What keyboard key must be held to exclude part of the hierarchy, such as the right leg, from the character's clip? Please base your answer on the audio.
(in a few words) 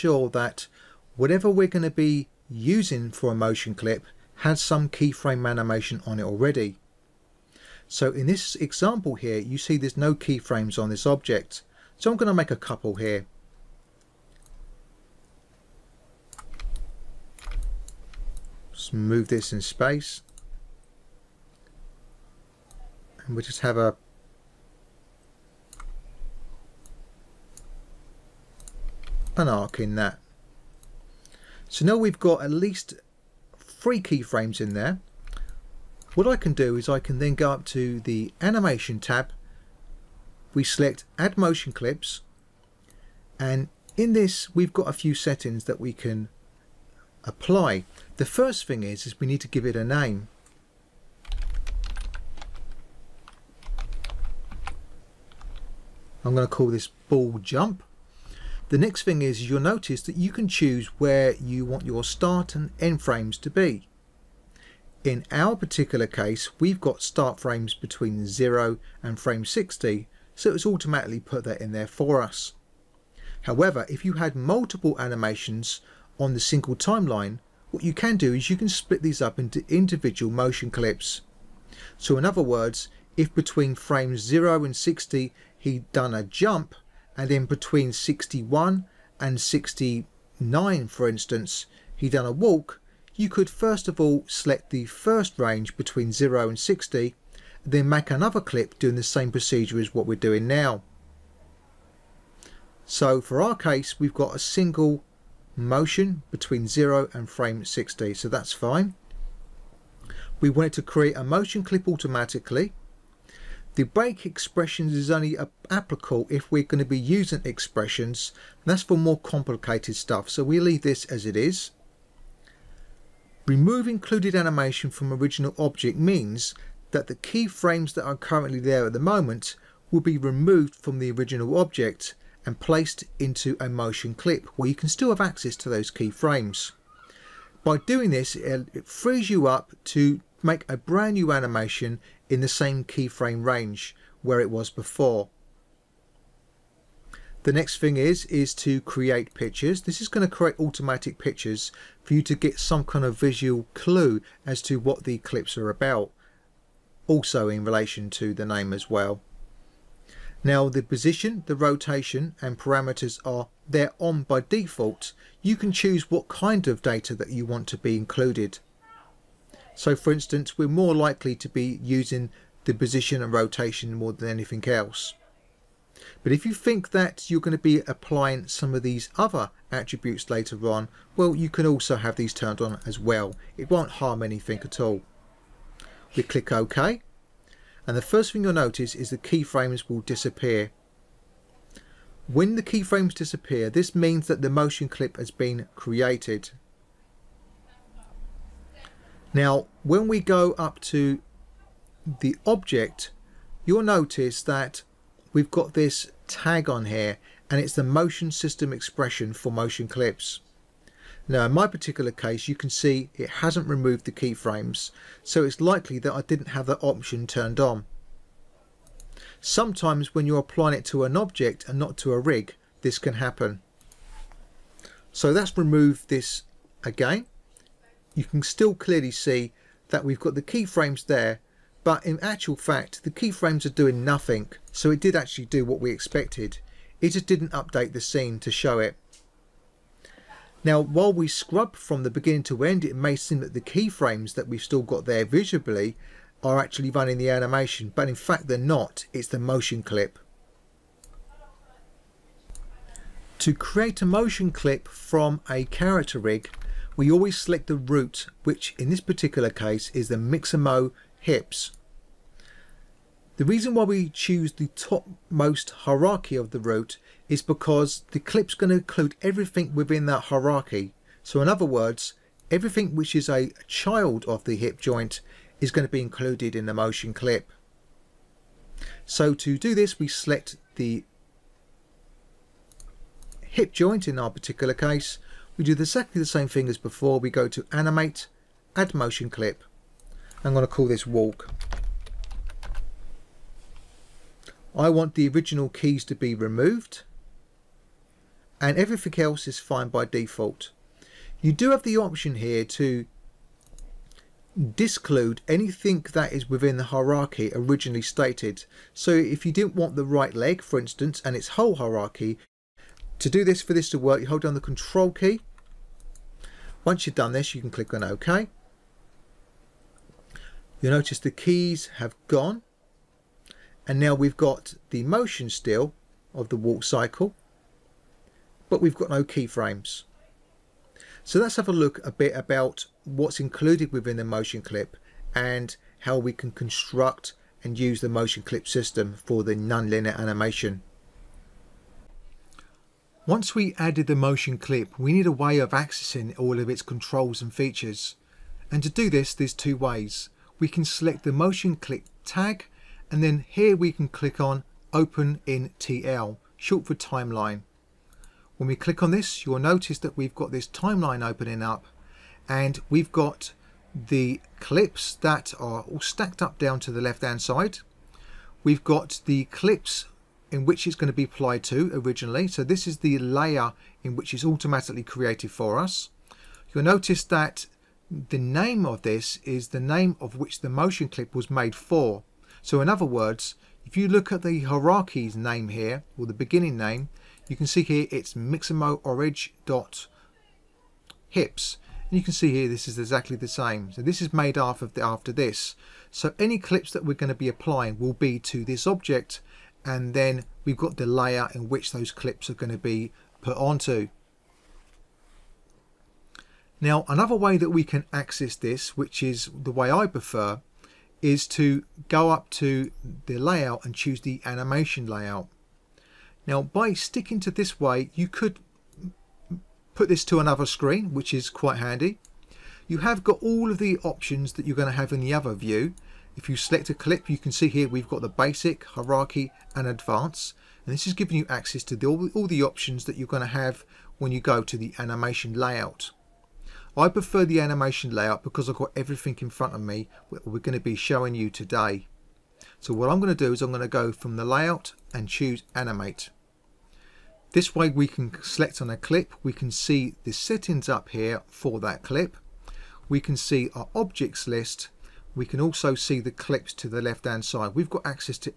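control.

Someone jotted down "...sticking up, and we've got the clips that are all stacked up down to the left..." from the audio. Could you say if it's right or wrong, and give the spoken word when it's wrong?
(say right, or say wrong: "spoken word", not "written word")
wrong: "opening", not "sticking".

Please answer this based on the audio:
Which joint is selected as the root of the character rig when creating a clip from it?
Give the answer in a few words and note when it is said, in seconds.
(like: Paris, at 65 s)
Mixamo hips, at 260 s.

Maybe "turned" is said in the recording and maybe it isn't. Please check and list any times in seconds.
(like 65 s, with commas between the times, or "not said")
182 s, 217 s.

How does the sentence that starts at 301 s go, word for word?
You do have the option here to disclude anything that is within the hierarchy originally stated.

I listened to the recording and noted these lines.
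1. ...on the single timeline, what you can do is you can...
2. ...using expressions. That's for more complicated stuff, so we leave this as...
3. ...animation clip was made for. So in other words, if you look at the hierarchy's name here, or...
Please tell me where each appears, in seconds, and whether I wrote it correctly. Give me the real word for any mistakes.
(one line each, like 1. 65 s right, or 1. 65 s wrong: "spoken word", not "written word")
1. 76 s right
2. 116 s right
3. 380 s wrong: "motion", not "animation".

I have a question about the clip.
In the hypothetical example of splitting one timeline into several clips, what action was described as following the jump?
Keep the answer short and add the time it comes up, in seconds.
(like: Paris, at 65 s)
a walk, at 92 s.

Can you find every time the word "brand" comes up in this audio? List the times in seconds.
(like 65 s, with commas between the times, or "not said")
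140 s.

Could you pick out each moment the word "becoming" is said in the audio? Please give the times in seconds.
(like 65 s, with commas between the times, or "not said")
not said.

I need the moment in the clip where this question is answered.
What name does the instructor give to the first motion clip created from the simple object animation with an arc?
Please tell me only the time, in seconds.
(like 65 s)
57 s.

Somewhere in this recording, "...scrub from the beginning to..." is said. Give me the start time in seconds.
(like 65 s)
241 s.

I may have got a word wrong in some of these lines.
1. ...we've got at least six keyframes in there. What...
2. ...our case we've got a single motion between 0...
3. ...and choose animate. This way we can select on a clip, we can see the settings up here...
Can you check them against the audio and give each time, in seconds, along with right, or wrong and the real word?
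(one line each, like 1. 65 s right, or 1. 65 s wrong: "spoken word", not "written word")
1. 31 s wrong: "three", not "six"
2. 103 s right
3. 445 s right.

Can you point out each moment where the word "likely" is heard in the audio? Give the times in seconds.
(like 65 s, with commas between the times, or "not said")
170 s, 215 s.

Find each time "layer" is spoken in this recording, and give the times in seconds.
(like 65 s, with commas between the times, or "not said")
373 s, 401 s.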